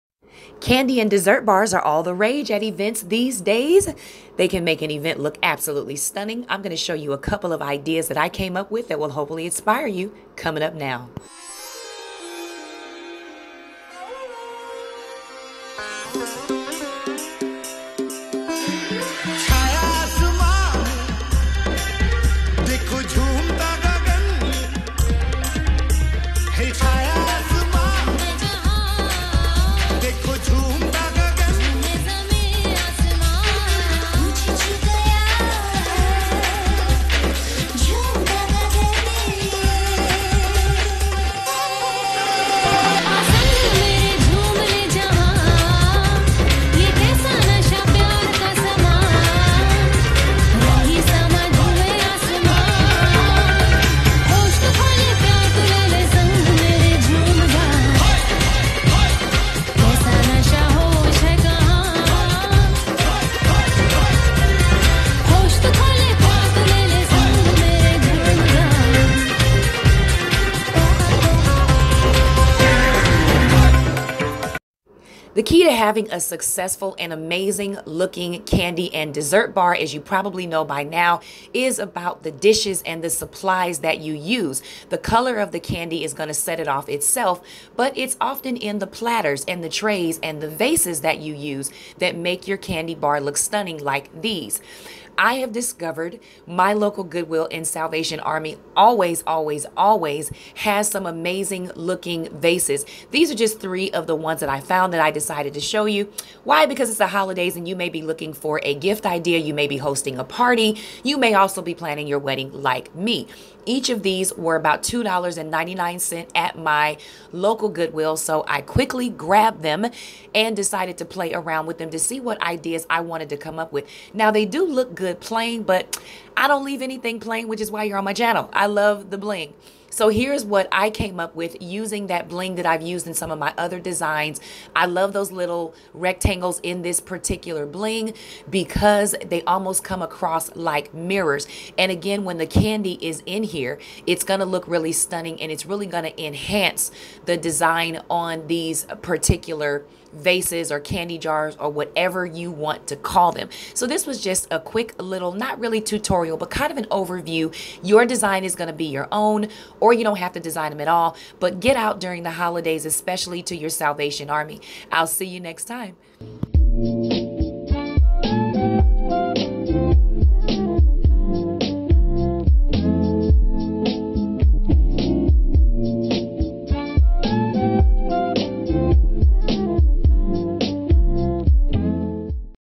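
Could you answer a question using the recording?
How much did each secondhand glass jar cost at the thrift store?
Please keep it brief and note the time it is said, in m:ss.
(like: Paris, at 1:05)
$2.99, at 1:54.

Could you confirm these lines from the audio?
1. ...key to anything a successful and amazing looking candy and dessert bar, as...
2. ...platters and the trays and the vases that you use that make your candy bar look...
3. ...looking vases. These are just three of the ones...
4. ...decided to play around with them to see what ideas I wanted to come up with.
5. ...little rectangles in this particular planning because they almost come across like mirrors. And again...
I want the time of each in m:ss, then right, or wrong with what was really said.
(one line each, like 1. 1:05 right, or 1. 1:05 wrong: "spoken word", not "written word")
1. 1:15 wrong: "having", not "anything"
2. 1:28 right
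3. 1:41 right
4. 2:00 right
5. 2:15 wrong: "bling", not "planning".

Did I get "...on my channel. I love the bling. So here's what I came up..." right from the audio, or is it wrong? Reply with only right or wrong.
right.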